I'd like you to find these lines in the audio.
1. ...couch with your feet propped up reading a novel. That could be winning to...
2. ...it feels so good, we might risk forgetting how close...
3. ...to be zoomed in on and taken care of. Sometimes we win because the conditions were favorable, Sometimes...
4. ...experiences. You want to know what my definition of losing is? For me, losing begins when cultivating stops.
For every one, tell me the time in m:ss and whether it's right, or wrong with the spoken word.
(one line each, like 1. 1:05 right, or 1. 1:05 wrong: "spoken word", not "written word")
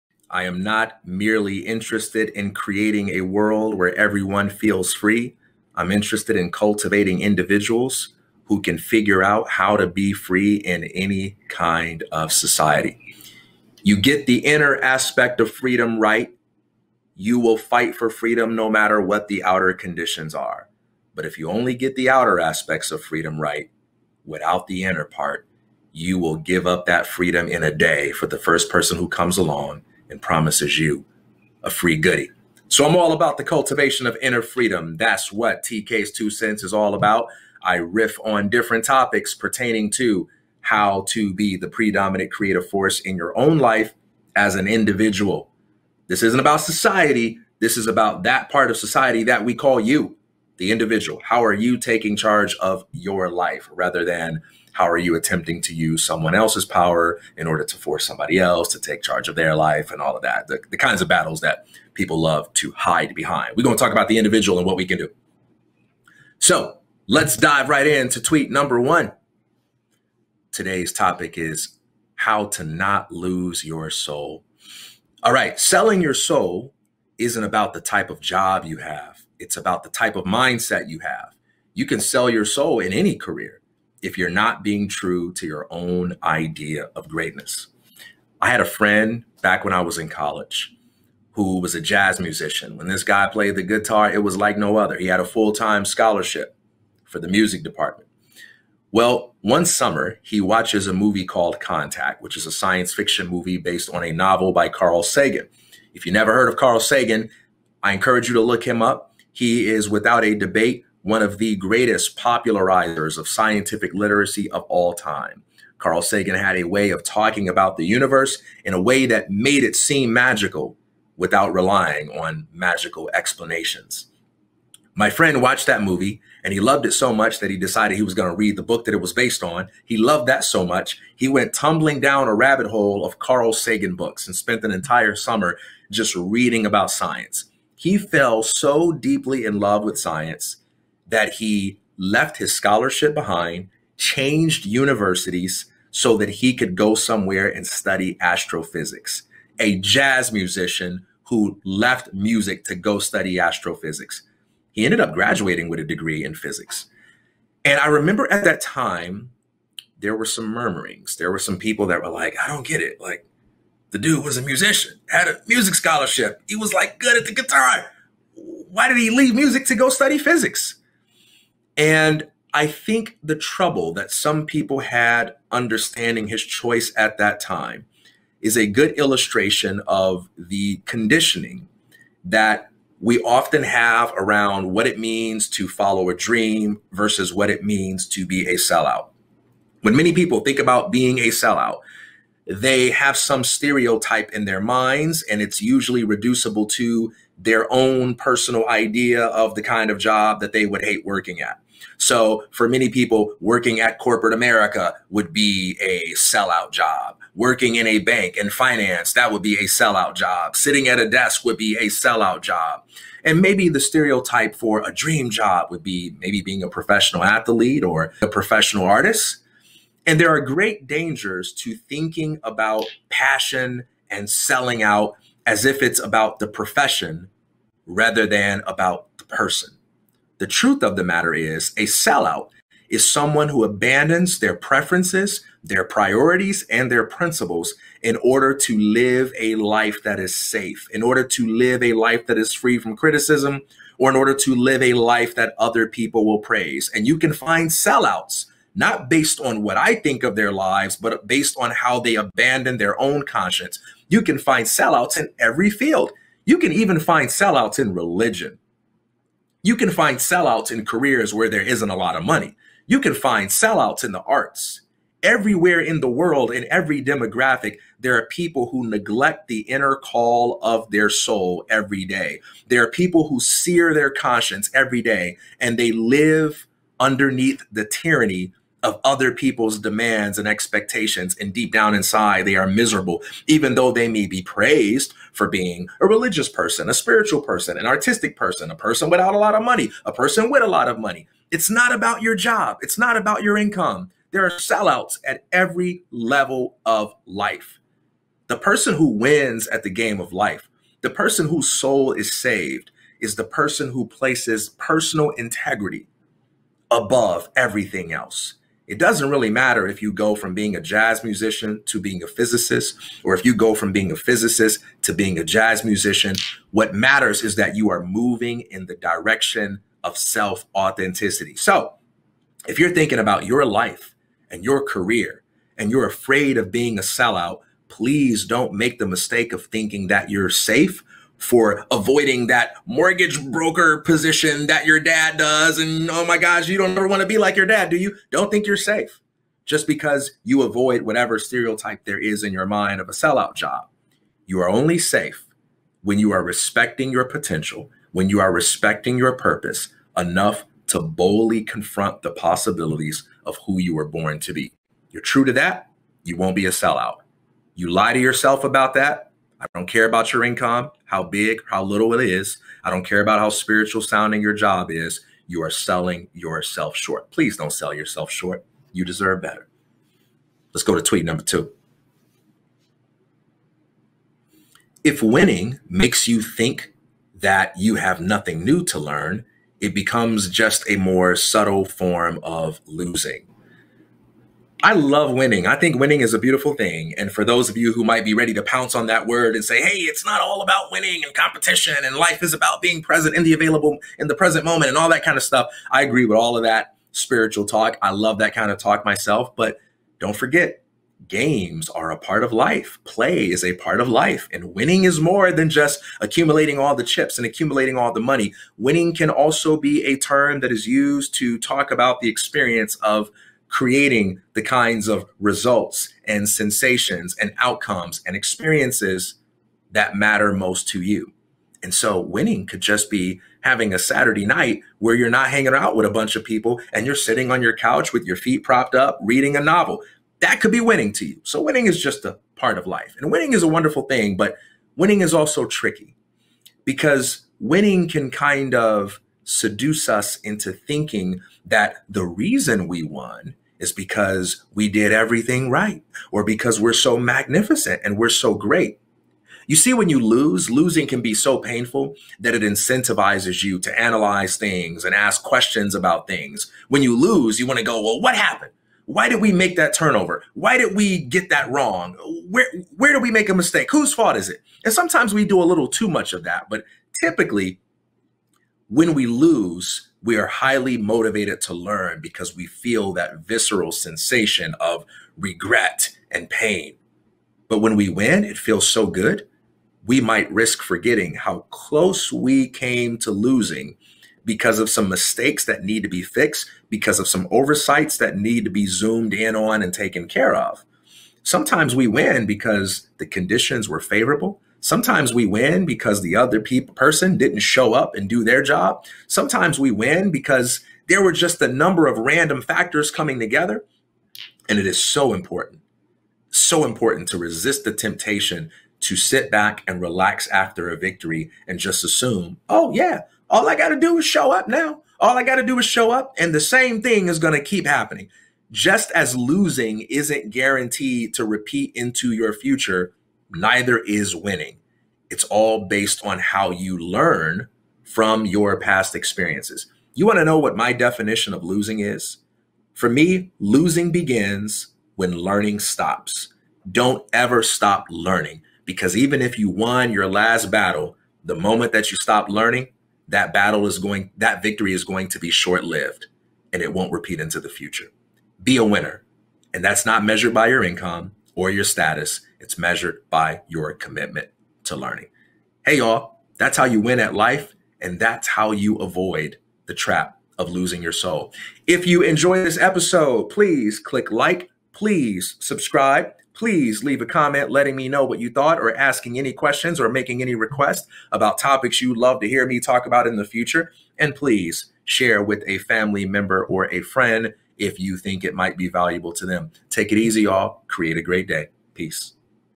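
1. 7:07 right
2. 7:58 right
3. 8:08 right
4. 8:49 wrong: "learning", not "cultivating".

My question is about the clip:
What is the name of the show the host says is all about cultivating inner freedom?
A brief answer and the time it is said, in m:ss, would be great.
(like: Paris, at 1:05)
TK's Two Cents, at 0:35.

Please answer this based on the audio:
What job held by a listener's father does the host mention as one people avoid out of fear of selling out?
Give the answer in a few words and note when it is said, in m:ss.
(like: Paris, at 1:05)
Mortgage broker, at 5:32.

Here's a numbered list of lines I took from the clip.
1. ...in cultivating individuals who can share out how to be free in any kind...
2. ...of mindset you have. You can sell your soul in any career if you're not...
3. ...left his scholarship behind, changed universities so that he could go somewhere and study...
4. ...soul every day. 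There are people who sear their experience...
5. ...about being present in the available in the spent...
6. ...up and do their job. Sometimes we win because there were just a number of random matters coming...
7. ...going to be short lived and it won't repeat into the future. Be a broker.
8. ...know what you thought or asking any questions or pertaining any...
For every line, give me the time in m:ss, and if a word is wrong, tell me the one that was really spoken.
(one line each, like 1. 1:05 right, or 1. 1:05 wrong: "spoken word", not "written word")
1. 0:06 wrong: "figure", not "share"
2. 1:20 right
3. 2:21 right
4. 4:31 wrong: "conscience", not "experience"
5. 6:32 wrong: "present", not "spent"
6. 8:17 wrong: "factors", not "matters"
7. 9:05 wrong: "winner", not "broker"
8. 9:28 wrong: "making", not "pertaining".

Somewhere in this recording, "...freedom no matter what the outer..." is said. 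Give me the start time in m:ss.
0:18.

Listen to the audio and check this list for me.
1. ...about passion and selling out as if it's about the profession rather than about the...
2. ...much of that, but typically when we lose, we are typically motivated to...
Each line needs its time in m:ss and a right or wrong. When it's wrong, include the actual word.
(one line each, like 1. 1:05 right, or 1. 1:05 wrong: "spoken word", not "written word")
1. 3:42 right
2. 7:46 wrong: "highly", not "typically".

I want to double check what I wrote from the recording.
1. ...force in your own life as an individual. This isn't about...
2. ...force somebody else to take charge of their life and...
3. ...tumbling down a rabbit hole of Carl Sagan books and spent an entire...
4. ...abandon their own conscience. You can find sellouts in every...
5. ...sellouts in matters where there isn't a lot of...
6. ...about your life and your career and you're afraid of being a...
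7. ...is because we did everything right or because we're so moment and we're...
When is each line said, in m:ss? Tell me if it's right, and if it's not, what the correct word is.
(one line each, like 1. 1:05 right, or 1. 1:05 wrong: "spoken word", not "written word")
1. 0:42 right
2. 0:57 right
3. 2:11 right
4. 4:12 right
5. 4:20 wrong: "careers", not "matters"
6. 5:23 right
7. 7:23 wrong: "magnificent", not "moment".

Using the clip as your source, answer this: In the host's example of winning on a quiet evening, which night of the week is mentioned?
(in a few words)
Saturday.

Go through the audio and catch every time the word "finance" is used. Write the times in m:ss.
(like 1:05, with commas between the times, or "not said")
3:28.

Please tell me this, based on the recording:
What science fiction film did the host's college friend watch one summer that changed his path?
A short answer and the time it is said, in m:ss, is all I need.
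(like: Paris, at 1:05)
Contact, at 1:41.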